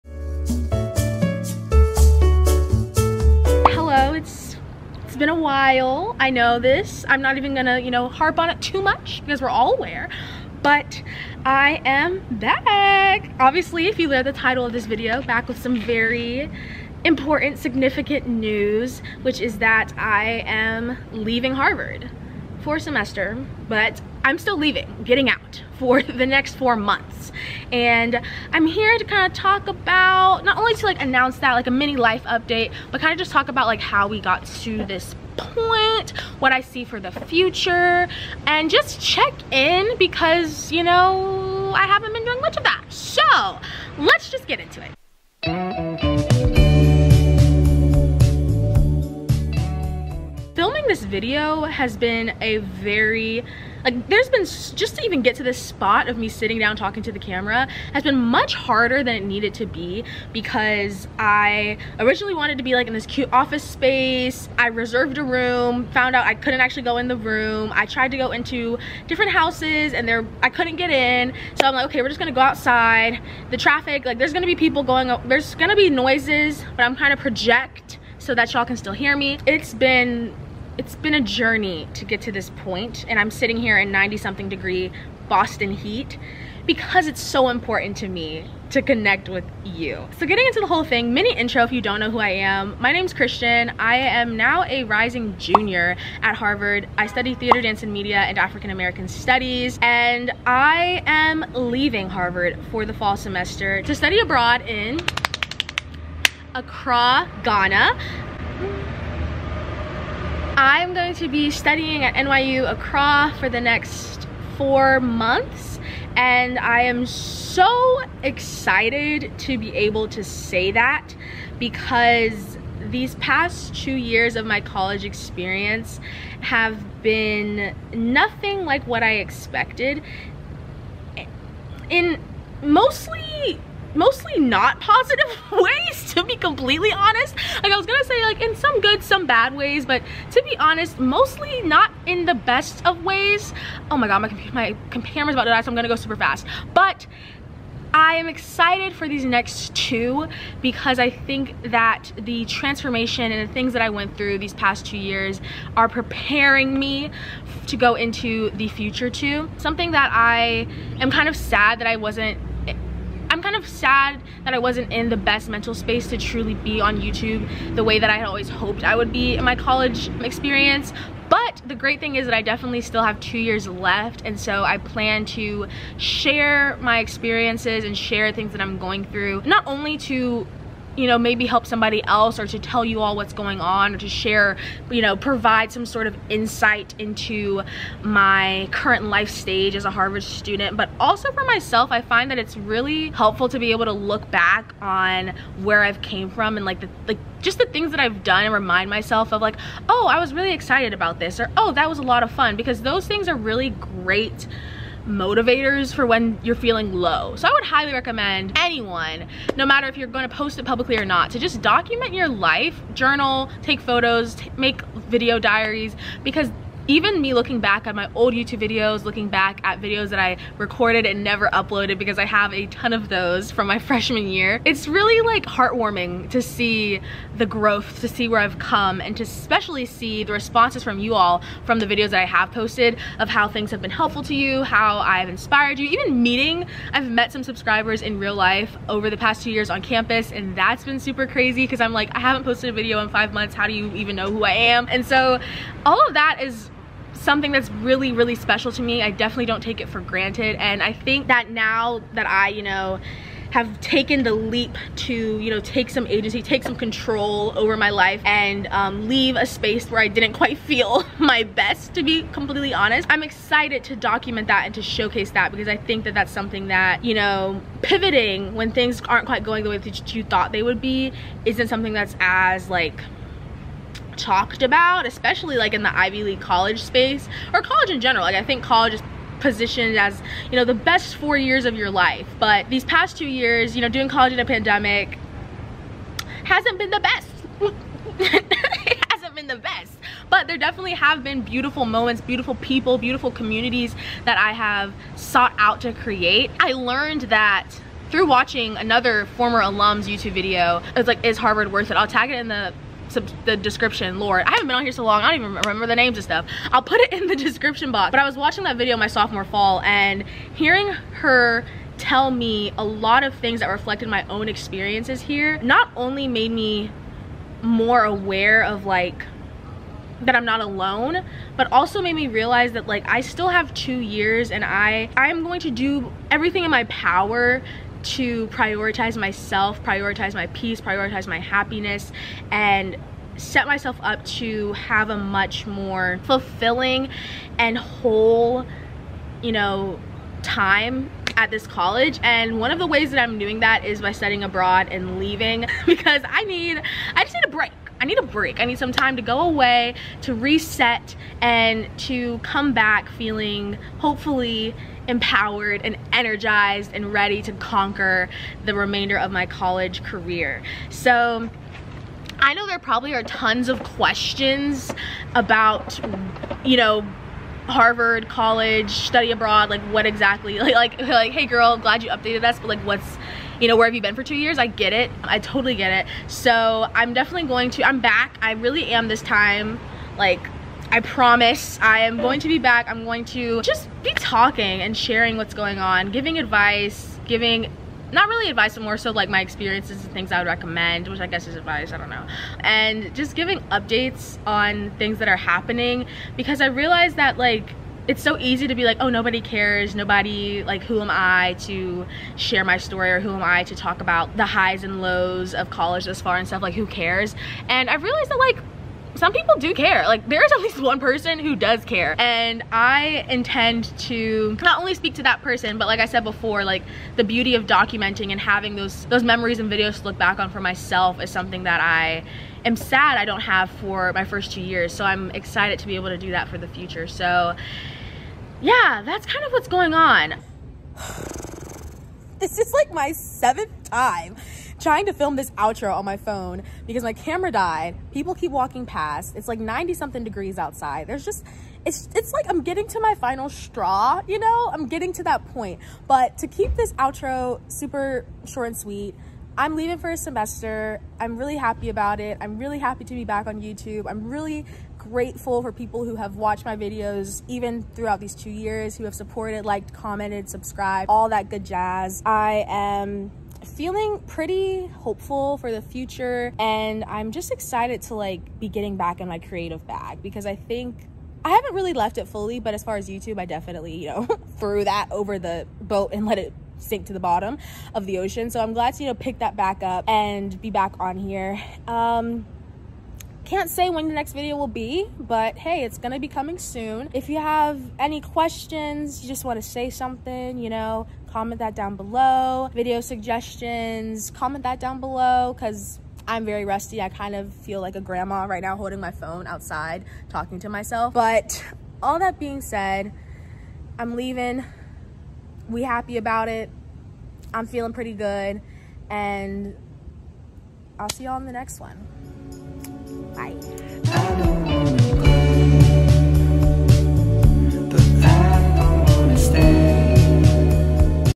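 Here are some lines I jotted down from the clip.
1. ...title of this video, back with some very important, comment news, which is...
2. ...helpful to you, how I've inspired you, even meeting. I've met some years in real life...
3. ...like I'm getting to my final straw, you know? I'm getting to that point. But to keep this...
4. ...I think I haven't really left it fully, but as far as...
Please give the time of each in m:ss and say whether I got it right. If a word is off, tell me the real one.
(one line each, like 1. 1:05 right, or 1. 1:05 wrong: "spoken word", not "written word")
1. 0:14 wrong: "significant", not "comment"
2. 3:53 wrong: "subscribers", not "years"
3. 7:22 right
4. 7:50 right.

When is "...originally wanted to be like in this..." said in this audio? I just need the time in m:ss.
1:01.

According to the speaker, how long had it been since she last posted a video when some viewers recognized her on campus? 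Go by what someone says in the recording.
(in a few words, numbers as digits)
5 months.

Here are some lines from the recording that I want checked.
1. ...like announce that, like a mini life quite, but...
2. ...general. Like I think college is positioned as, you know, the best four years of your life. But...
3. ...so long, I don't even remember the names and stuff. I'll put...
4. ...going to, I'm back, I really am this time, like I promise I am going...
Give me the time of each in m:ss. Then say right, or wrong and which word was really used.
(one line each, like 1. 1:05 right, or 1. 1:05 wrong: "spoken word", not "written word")
1. 0:30 wrong: "update", not "quite"
2. 4:38 right
3. 5:04 right
4. 6:17 right.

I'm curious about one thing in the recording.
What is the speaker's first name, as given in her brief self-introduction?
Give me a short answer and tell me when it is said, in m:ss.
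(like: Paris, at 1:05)
Kristian, at 1:33.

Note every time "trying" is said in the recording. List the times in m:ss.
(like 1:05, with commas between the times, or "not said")
1:16, 7:14.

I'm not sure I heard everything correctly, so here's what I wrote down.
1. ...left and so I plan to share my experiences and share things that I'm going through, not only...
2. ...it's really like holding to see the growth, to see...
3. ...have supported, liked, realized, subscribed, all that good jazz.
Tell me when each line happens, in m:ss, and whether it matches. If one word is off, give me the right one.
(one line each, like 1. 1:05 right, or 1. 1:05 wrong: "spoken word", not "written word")
1. 2:53 right
2. 3:44 wrong: "heartwarming", not "holding"
3. 7:39 wrong: "commented", not "realized".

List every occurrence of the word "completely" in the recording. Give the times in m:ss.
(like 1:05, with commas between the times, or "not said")
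2:16, 4:22.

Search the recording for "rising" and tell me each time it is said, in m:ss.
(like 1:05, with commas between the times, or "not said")
1:34.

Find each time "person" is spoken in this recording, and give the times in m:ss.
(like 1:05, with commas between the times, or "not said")
6:50, 6:55.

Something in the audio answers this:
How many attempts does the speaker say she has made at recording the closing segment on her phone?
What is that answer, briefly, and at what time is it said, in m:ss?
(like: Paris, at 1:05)
7, at 7:13.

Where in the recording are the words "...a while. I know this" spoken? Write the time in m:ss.
0:05.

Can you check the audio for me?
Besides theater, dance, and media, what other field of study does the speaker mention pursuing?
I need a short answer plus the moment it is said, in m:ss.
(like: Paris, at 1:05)
African American studies, at 1:38.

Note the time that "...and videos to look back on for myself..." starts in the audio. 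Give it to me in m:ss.
6:59.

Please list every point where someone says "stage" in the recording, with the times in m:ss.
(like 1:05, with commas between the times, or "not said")
3:09.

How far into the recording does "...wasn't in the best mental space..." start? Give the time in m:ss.
2:44.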